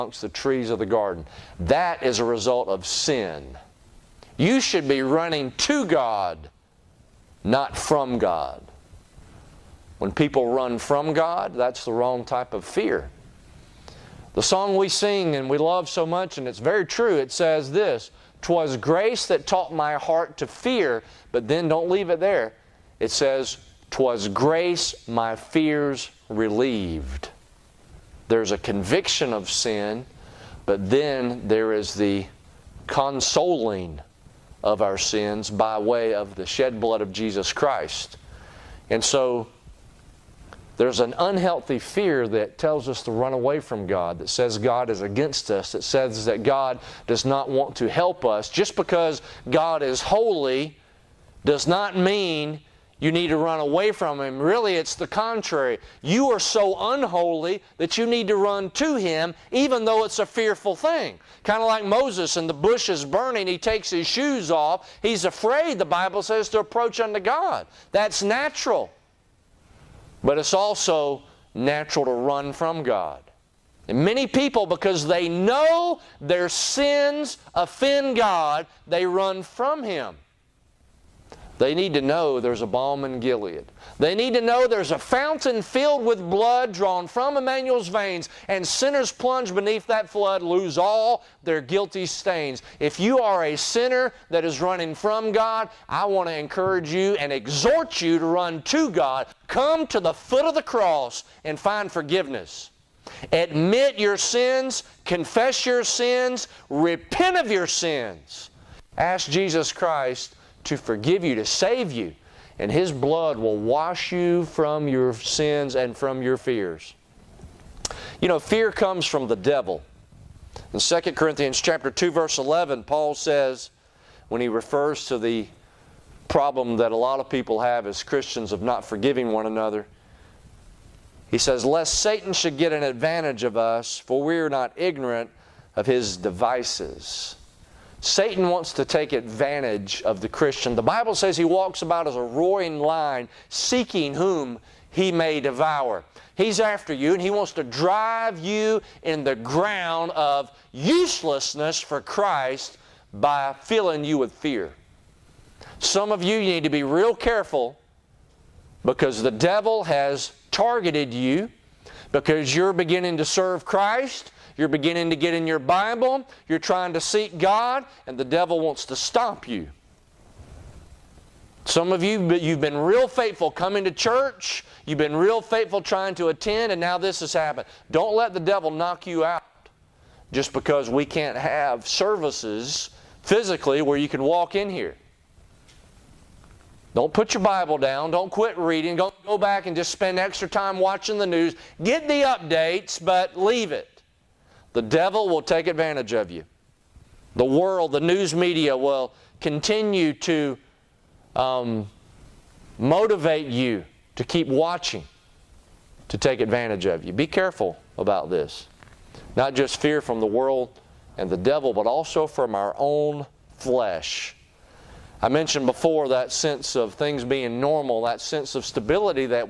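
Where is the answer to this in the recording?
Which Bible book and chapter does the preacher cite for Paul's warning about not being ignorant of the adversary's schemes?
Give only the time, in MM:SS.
02:00.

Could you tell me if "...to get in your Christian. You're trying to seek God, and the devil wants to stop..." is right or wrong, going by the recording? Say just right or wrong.
wrong.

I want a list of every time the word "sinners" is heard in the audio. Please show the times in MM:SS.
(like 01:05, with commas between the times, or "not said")
01:28, 01:33.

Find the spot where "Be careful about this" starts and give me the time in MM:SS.
03:27.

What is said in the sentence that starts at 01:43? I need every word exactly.
Admit your sins, confess your sins, repent of your sins.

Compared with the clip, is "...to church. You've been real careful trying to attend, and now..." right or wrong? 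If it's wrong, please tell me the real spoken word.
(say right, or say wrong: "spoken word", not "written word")
wrong: "faithful", not "careful".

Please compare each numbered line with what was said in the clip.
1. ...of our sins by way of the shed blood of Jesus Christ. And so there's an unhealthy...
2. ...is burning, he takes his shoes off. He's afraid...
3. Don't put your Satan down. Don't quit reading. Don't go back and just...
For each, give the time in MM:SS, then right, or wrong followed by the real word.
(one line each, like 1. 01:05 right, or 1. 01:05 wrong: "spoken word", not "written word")
1. 00:34 right
2. 01:02 right
3. 03:06 wrong: "Bible", not "Satan".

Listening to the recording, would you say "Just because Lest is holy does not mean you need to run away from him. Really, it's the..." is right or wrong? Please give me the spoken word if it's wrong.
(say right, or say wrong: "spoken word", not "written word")
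wrong: "God", not "Lest".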